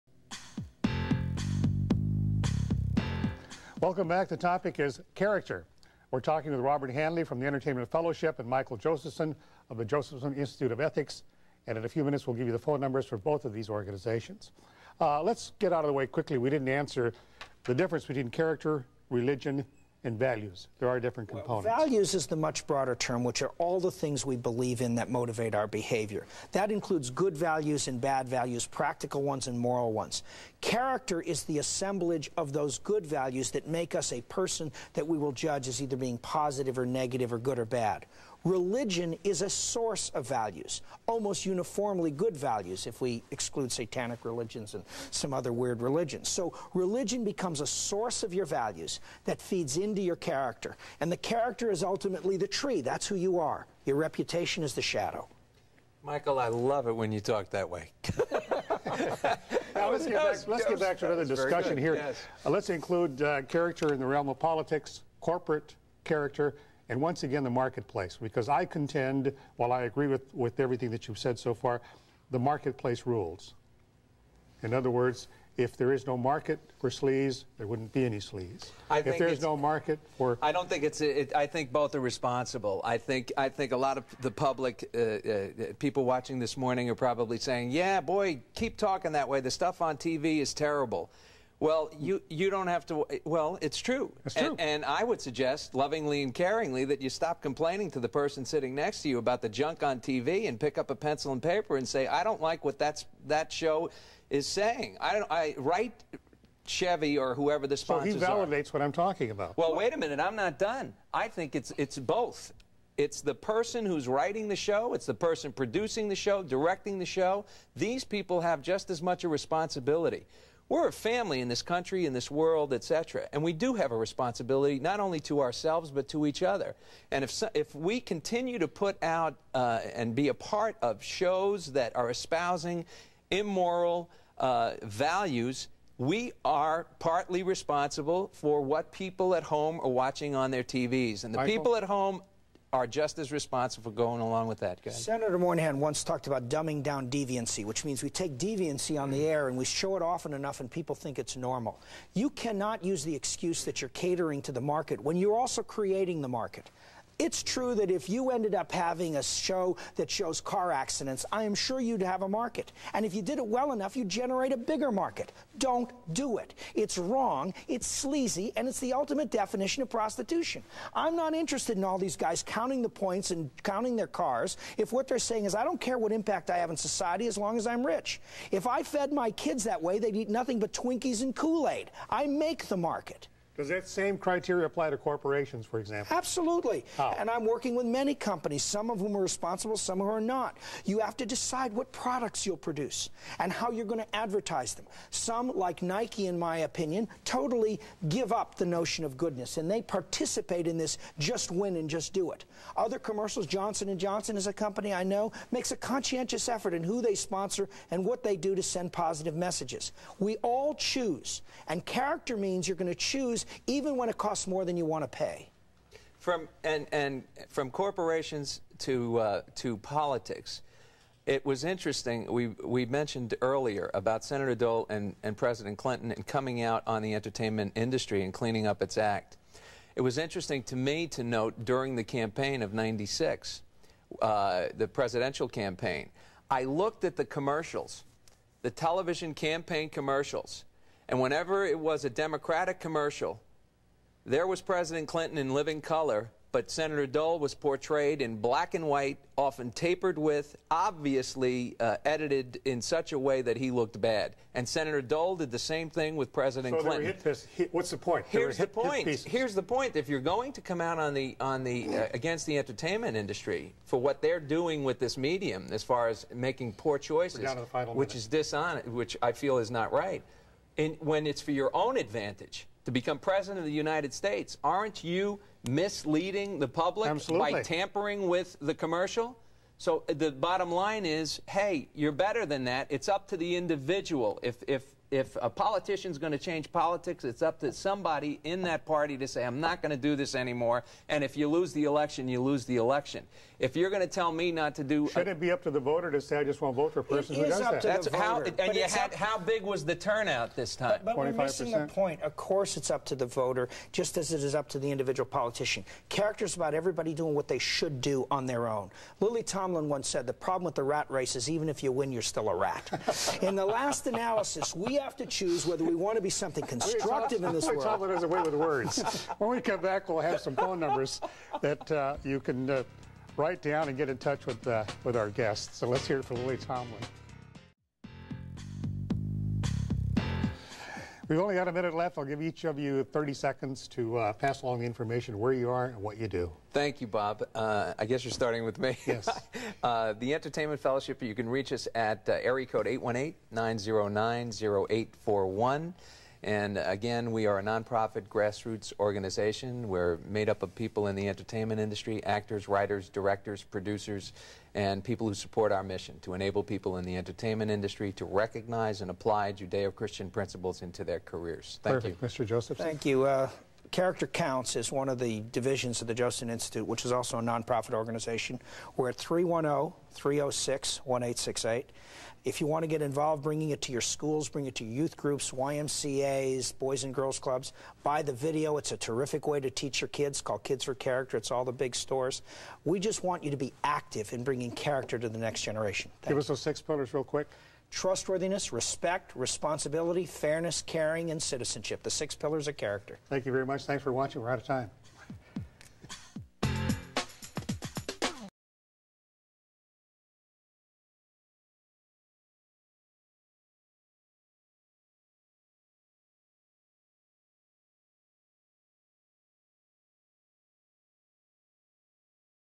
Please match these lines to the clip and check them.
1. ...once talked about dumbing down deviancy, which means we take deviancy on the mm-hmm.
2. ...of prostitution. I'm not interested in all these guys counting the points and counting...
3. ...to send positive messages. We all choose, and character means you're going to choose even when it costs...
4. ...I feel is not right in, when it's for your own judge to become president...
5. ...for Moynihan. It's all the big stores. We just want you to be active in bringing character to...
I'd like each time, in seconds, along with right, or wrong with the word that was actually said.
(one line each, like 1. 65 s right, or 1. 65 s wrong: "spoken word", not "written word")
1. 145 s right
2. 169 s right
3. 208 s right
4. 269 s wrong: "advantage", not "judge"
5. 380 s wrong: "Character", not "Moynihan".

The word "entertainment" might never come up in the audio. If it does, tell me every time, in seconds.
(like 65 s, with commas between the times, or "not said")
7 s, 227 s, 262 s, 340 s, 351 s, 357 s.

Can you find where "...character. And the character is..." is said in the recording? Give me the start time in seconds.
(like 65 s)
50 s.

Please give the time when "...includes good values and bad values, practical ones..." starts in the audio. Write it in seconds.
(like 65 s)
26 s.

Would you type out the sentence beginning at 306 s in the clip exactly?
Character's about everybody doing what they should do on their own.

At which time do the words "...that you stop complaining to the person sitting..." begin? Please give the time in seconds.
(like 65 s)
96 s.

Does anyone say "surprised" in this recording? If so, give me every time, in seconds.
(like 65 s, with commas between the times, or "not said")
not said.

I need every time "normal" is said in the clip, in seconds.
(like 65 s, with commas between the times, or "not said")
151 s.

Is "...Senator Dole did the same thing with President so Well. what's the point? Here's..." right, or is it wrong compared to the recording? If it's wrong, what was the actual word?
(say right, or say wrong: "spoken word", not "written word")
wrong: "Clinton", not "Well".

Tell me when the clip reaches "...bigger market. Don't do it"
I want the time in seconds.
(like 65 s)
164 s.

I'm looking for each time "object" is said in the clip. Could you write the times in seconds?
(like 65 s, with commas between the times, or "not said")
not said.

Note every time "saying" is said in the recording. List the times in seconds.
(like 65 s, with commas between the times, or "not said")
87 s, 104 s, 175 s.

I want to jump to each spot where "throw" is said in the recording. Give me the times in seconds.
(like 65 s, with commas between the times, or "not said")
not said.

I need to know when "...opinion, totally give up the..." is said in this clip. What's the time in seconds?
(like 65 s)
196 s.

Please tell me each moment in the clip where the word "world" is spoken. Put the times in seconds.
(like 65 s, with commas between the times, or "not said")
122 s, 317 s.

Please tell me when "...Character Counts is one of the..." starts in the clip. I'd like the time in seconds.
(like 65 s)
363 s.